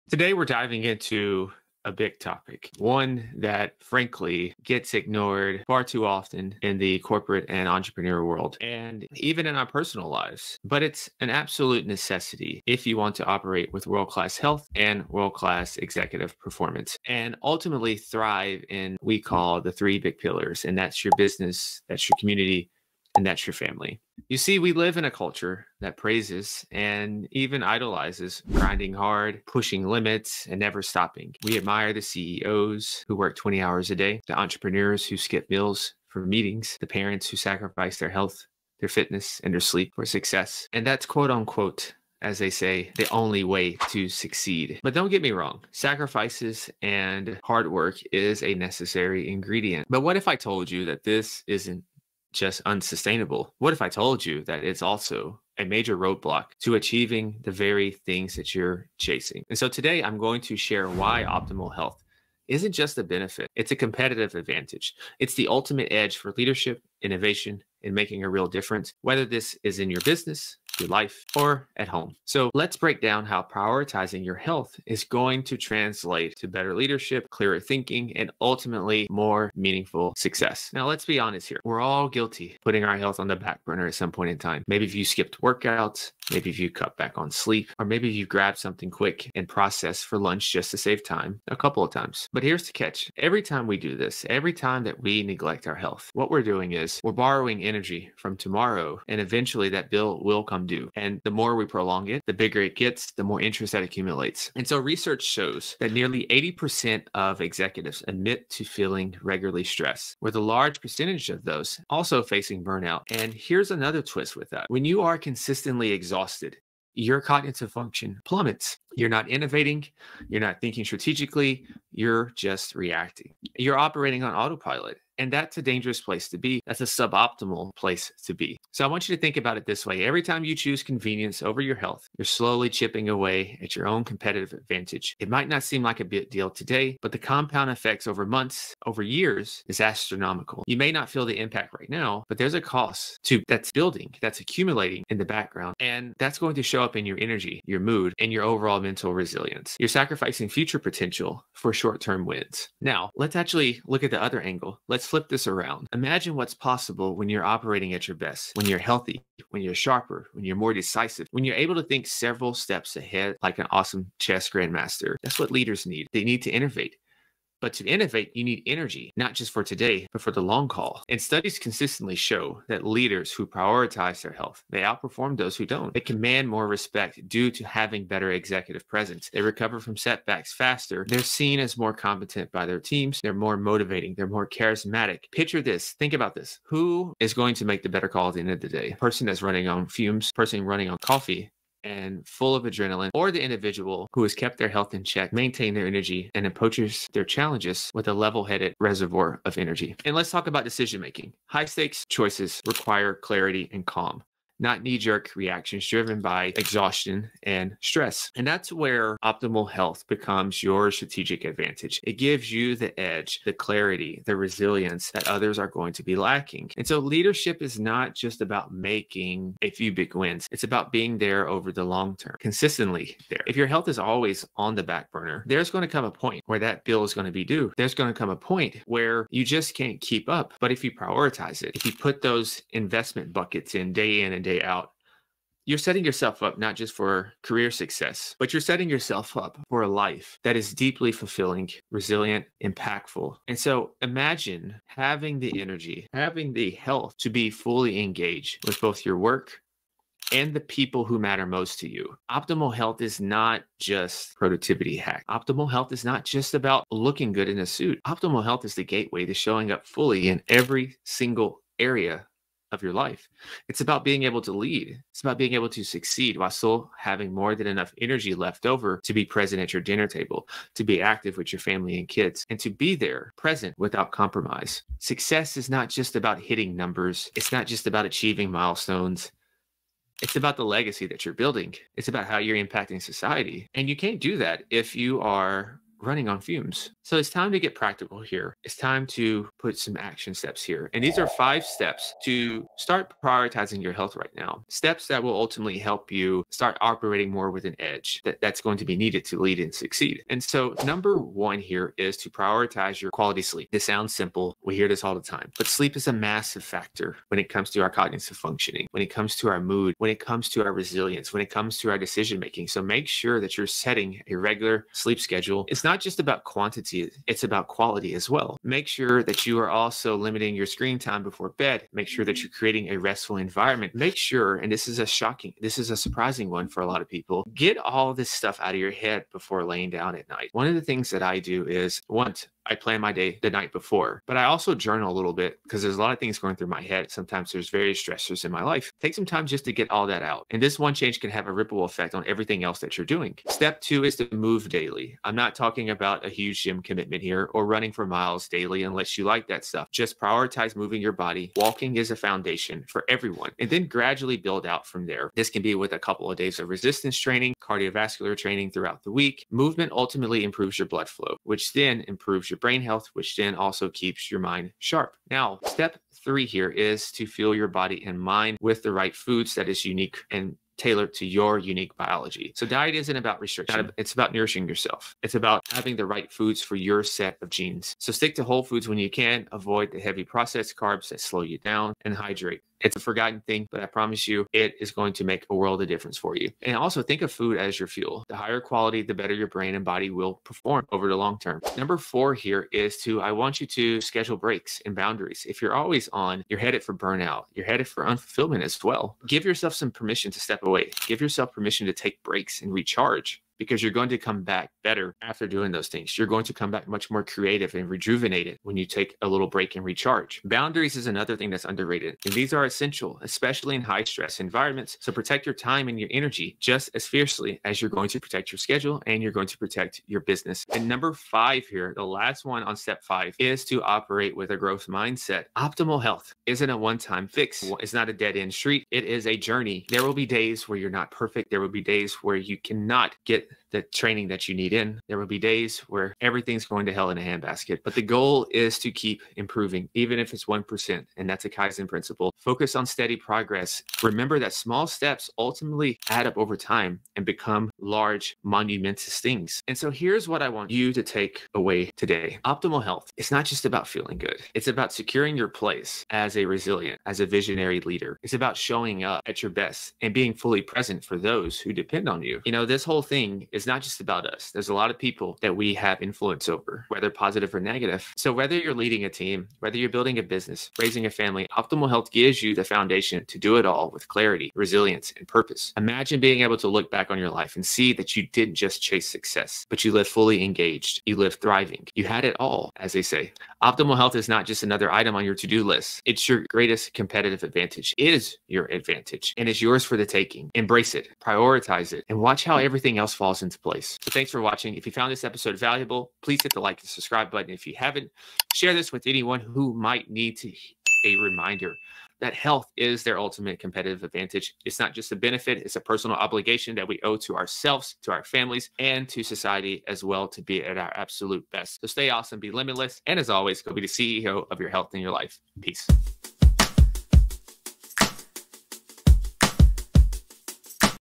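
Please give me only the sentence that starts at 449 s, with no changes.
And so here's what I want you to take away today optimal health.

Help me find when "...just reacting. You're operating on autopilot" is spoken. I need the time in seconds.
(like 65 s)
122 s.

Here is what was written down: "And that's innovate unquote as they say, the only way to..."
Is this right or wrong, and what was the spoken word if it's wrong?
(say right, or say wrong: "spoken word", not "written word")
wrong: "quote", not "innovate".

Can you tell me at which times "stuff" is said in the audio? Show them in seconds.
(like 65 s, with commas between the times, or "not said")
328 s, 349 s.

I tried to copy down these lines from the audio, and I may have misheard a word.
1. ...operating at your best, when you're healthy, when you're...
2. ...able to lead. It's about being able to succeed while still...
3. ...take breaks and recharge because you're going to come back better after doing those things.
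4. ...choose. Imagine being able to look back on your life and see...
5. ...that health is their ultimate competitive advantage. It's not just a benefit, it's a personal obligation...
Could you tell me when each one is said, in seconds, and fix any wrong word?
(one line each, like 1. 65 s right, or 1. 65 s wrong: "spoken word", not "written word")
1. 157 s right
2. 264 s right
3. 401 s right
4. 475 s wrong: "purpose", not "choose"
5. 502 s right.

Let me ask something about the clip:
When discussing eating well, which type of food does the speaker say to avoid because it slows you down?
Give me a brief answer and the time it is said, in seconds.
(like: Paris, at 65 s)
Heavy processed carbs, at 379 s.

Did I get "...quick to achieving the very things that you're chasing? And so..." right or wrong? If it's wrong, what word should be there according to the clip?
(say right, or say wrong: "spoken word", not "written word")
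wrong: "roadblock", not "quick".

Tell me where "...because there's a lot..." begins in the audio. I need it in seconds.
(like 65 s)
335 s.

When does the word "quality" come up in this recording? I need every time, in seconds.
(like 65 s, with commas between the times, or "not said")
303 s, 317 s, 388 s.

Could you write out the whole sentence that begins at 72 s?
So let's break down how prioritizing your health is going to translate to better leadership, clearer thinking, and ultimately more meaningful success.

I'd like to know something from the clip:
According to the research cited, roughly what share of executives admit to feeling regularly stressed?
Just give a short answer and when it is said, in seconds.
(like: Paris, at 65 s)
80%, at 106 s.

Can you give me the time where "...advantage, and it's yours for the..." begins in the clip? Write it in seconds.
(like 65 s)
488 s.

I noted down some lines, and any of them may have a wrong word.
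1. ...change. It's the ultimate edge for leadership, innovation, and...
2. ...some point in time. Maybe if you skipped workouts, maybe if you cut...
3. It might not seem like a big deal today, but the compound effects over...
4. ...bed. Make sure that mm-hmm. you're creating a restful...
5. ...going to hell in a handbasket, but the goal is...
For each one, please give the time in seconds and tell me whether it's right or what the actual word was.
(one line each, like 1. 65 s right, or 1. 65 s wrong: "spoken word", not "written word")
1. 64 s wrong: "advantage", not "change"
2. 83 s right
3. 135 s right
4. 321 s right
5. 436 s right.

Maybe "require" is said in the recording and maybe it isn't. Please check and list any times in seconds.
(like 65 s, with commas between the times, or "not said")
202 s.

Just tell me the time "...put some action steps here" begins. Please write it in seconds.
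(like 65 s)
289 s.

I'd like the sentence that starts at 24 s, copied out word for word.
You see, we live in a culture that praises and even idolizes grinding hard, pushing limits, and never stopping.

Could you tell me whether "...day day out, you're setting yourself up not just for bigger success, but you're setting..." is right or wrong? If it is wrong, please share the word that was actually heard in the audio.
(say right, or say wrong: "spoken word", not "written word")
wrong: "career", not "bigger".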